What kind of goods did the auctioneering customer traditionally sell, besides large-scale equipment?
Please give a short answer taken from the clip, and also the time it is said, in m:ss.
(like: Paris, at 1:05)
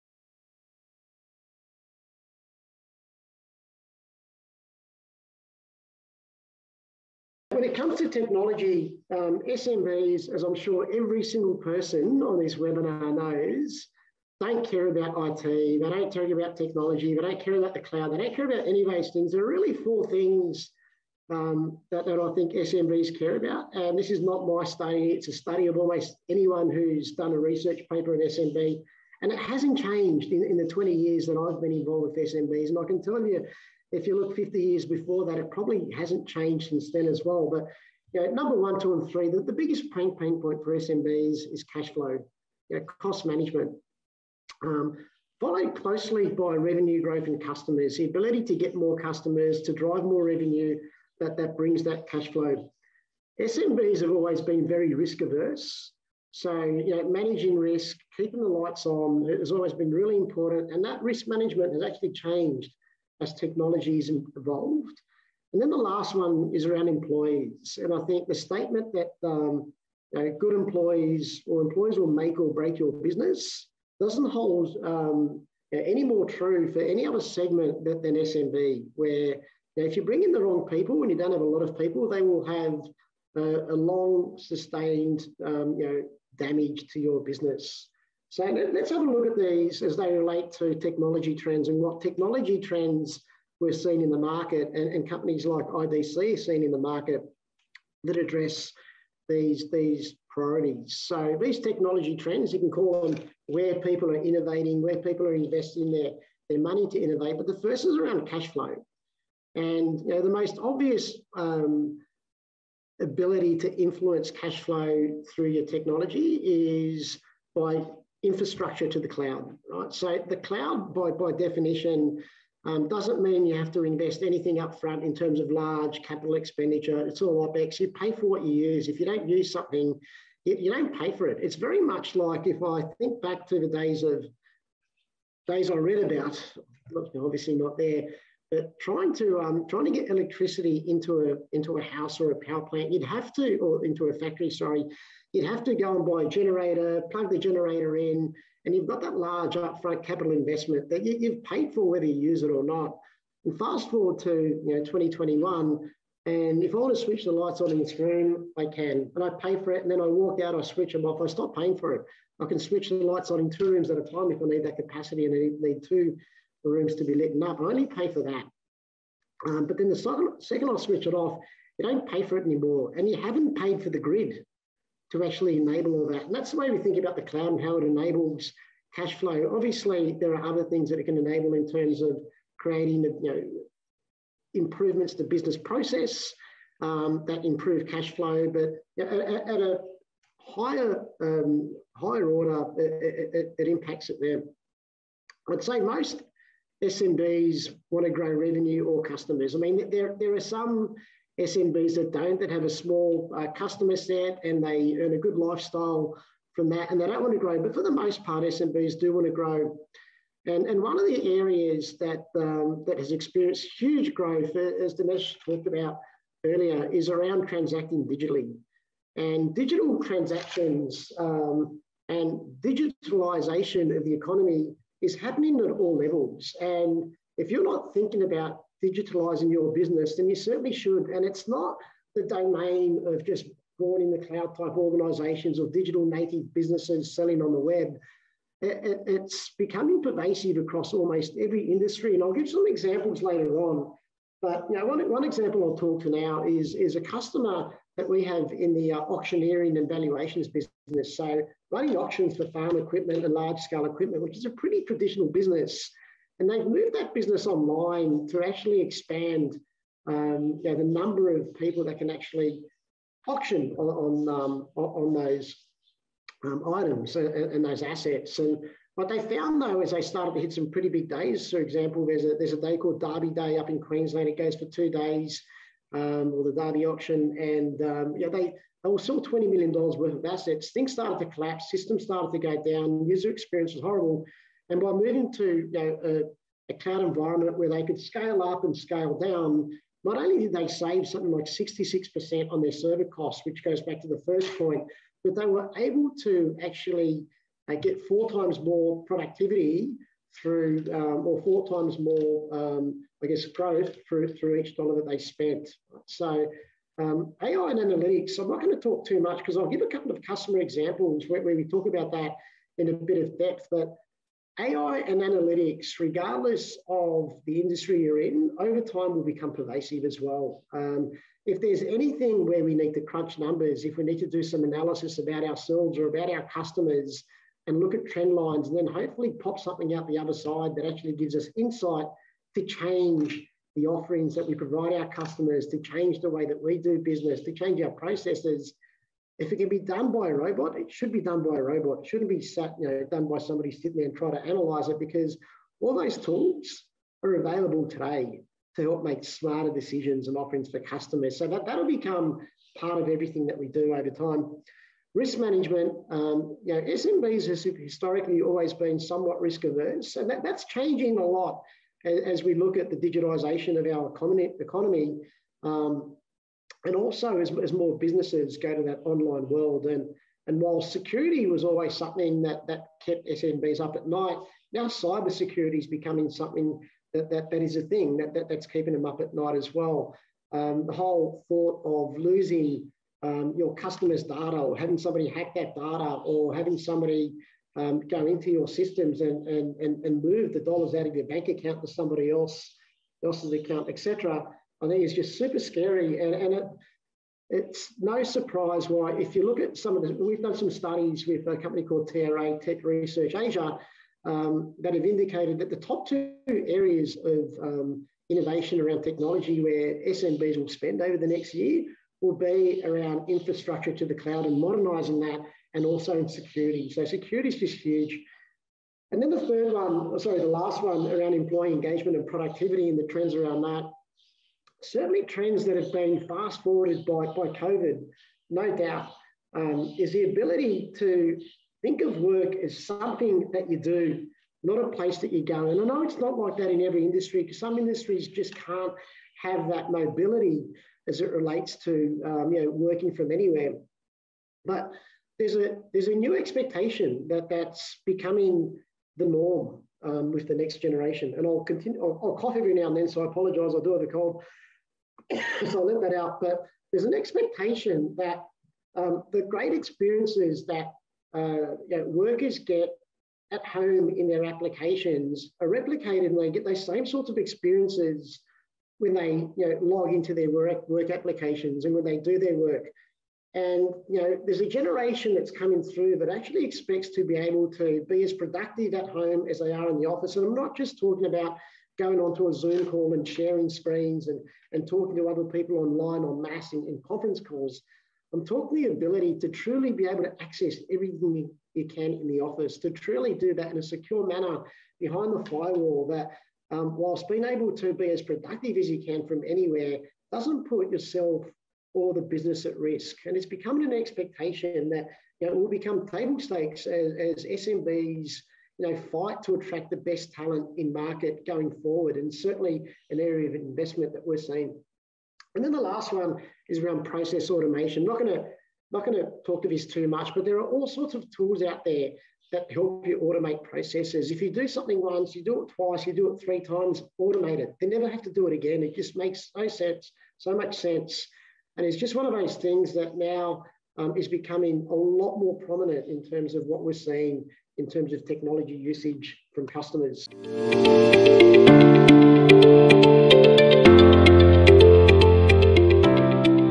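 farm equipment, at 4:12.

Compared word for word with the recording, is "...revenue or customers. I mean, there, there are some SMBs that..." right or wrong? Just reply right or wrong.
right.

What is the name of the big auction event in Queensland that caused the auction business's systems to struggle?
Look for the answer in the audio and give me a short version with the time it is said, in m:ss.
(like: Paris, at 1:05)
Derby Day, at 4:33.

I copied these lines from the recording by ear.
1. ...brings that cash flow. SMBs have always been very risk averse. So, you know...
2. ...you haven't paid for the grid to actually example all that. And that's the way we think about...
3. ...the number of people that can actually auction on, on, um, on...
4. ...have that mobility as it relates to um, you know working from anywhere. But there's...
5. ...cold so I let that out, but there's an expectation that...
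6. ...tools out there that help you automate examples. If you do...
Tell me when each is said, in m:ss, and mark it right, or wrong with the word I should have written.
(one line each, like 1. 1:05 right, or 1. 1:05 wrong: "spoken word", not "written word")
1. 0:51 right
2. 2:53 wrong: "enable", not "example"
3. 4:20 right
4. 7:19 right
5. 7:34 right
6. 8:41 wrong: "processes", not "examples".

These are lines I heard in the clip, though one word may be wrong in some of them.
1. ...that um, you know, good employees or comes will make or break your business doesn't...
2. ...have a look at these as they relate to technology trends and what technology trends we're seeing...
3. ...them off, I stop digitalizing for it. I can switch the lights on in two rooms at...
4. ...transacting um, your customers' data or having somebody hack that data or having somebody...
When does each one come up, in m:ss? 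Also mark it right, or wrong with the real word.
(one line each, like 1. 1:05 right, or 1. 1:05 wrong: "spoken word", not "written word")
1. 1:08 wrong: "employees", not "comes"
2. 1:28 right
3. 2:40 wrong: "paying", not "digitalizing"
4. 6:22 wrong: "losing", not "transacting".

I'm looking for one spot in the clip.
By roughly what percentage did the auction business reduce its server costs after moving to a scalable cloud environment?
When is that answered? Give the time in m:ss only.
4:51.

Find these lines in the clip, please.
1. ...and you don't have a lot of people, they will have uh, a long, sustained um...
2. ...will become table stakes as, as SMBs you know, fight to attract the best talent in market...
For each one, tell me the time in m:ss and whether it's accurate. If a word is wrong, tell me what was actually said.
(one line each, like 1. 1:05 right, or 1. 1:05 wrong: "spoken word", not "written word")
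1. 1:21 right
2. 8:25 right.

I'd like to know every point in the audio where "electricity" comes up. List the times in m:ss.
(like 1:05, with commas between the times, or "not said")
2:20.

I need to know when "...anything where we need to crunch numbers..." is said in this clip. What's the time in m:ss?
5:21.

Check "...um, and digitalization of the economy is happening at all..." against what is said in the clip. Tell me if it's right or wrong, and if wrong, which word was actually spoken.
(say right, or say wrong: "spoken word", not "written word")
right.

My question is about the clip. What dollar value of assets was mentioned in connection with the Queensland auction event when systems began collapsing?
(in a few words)
$20 million.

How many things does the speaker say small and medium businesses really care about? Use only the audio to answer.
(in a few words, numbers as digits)
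4.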